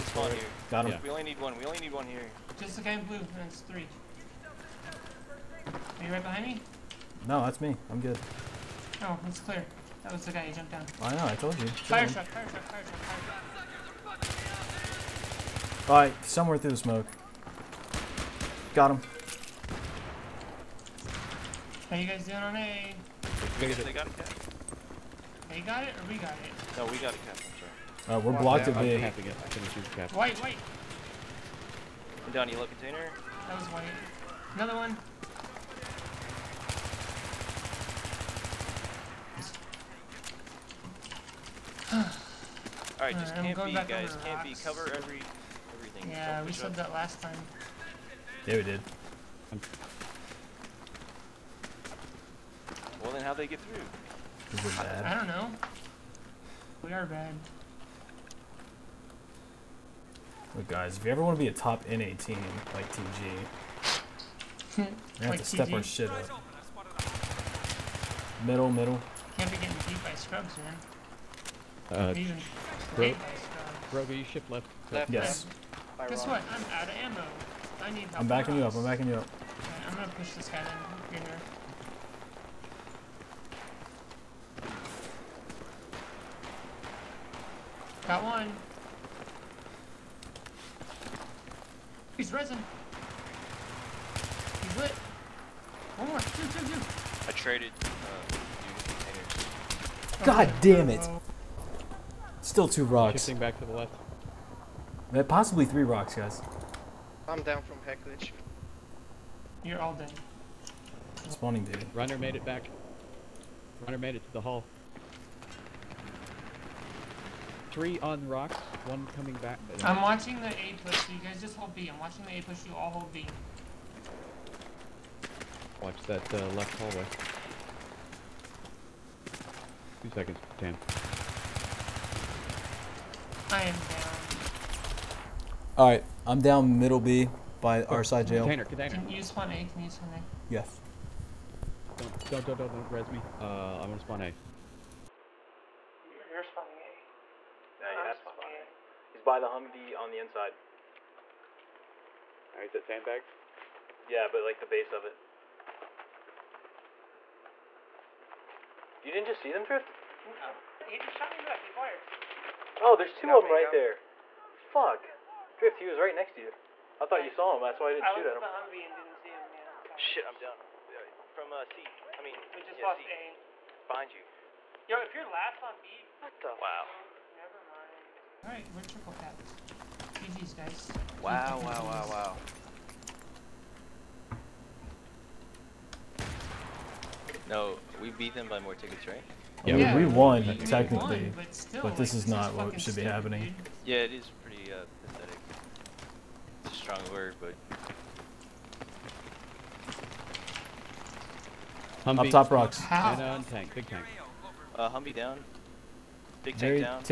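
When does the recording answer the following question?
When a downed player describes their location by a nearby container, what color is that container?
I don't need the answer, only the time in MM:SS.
00:32.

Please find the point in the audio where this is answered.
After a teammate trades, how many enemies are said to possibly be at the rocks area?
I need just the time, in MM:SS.
01:45.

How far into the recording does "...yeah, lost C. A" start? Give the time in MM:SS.
02:52.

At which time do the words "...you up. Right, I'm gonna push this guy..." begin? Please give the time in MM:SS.
01:19.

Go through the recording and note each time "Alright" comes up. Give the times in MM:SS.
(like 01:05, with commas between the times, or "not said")
00:42, 02:15, 02:58.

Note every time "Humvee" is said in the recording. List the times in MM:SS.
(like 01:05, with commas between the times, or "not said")
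02:29, 02:48, 03:24.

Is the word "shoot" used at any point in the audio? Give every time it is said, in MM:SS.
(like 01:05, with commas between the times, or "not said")
00:29, 02:48.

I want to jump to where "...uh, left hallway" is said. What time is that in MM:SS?
02:06.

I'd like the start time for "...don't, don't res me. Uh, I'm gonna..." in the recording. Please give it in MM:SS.
02:22.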